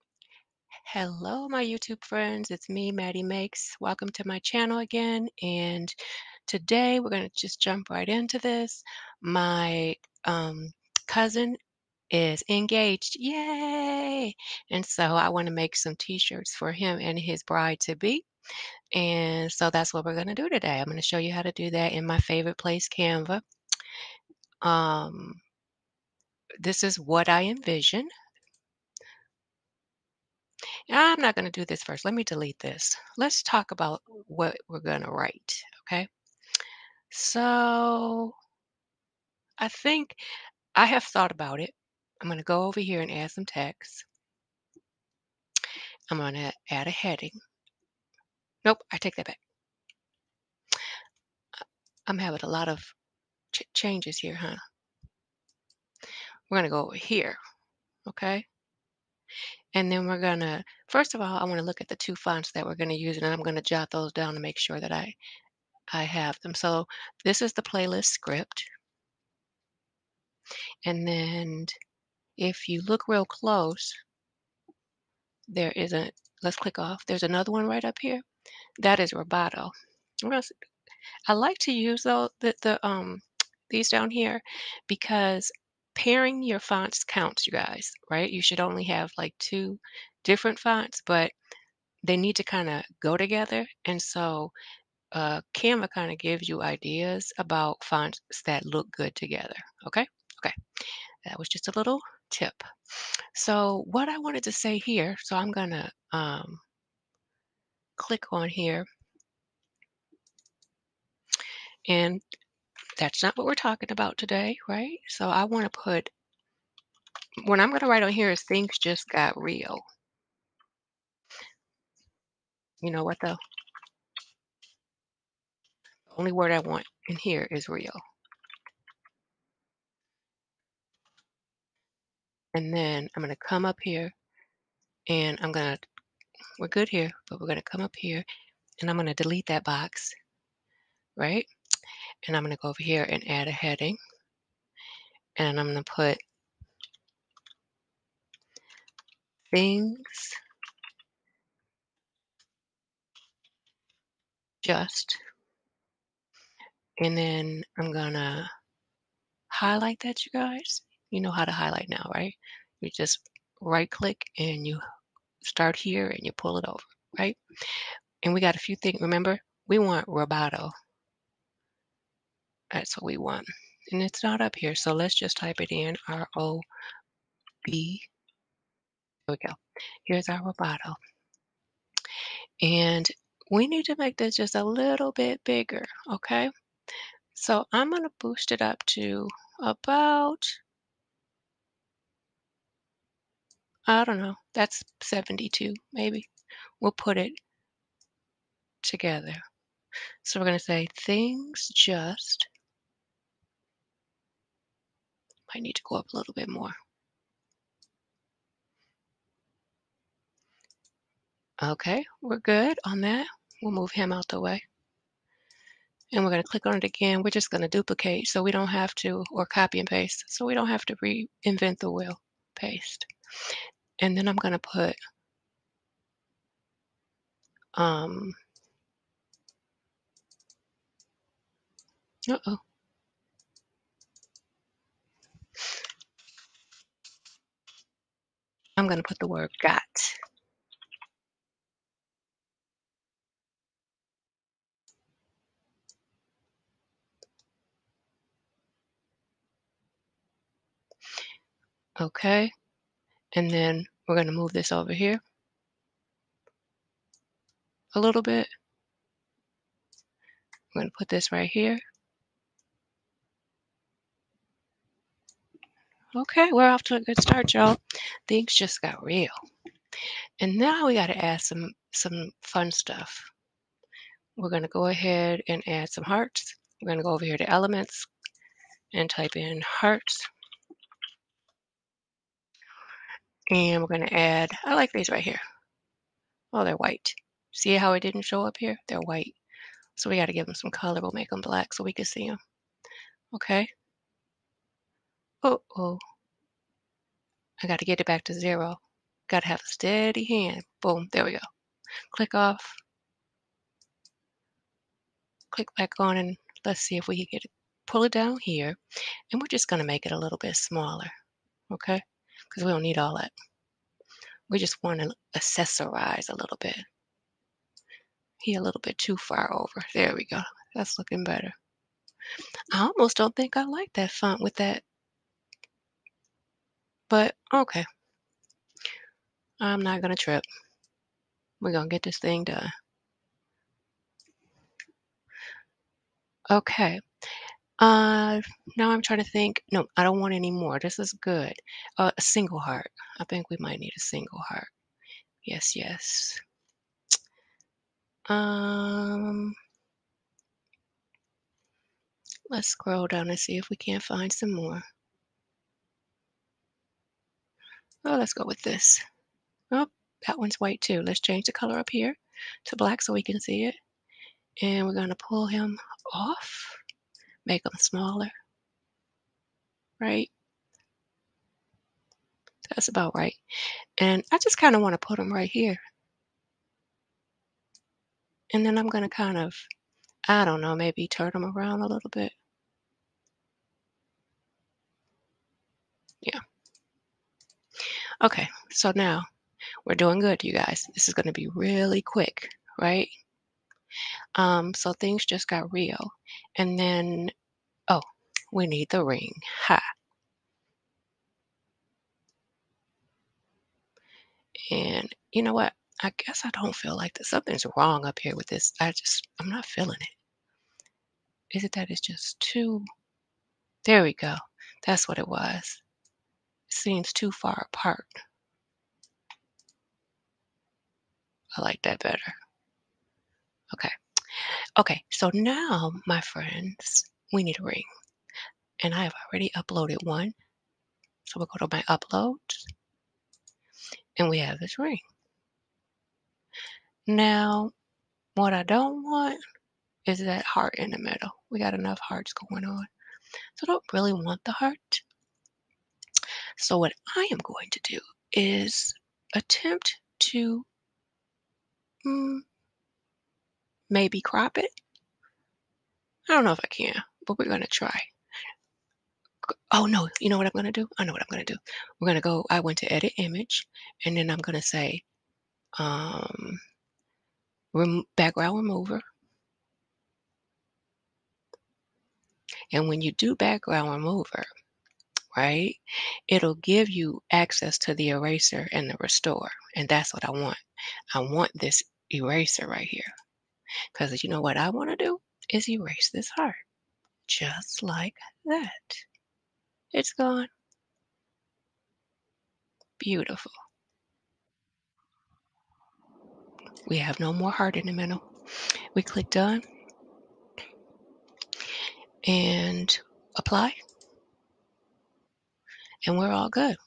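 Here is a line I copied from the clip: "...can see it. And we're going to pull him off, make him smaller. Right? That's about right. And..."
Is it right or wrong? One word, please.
right.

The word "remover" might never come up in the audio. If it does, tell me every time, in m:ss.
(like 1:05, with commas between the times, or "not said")
7:48, 7:53.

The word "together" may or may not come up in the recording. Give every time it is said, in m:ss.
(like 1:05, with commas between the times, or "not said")
1:33, 1:39, 3:18.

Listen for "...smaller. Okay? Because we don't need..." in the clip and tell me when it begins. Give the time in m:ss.
5:10.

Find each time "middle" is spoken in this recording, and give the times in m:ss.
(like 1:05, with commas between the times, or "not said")
7:20, 8:17.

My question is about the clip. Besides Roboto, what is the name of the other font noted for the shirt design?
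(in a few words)
Playlist Script.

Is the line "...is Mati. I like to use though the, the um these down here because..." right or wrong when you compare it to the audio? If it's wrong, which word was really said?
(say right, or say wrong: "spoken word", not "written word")
wrong: "Roboto", not "Mati".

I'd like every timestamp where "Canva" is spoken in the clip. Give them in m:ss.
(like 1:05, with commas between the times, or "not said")
0:22, 1:35.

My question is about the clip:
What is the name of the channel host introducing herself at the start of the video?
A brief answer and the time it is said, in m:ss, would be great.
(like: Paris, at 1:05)
Mati Makes, at 0:02.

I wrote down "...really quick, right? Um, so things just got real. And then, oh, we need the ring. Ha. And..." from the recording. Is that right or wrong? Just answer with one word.
right.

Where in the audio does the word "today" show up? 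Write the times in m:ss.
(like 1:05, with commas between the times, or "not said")
0:06, 0:20, 1:54.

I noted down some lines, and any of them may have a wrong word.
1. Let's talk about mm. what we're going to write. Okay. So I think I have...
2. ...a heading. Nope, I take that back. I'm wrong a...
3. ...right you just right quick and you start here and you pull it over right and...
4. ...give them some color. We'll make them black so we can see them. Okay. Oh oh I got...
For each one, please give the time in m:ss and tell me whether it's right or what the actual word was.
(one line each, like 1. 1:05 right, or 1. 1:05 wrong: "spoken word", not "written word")
1. 0:33 right
2. 0:46 wrong: "having", not "wrong"
3. 2:42 wrong: "click", not "quick"
4. 4:50 right.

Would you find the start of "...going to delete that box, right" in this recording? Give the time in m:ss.
2:18.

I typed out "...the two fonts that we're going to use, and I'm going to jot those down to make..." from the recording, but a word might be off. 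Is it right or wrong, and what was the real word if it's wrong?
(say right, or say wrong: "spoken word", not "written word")
right.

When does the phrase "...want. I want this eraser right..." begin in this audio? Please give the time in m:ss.
8:00.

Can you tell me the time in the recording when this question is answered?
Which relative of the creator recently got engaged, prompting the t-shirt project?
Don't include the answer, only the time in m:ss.
0:11.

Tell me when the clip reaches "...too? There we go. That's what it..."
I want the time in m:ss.
6:52.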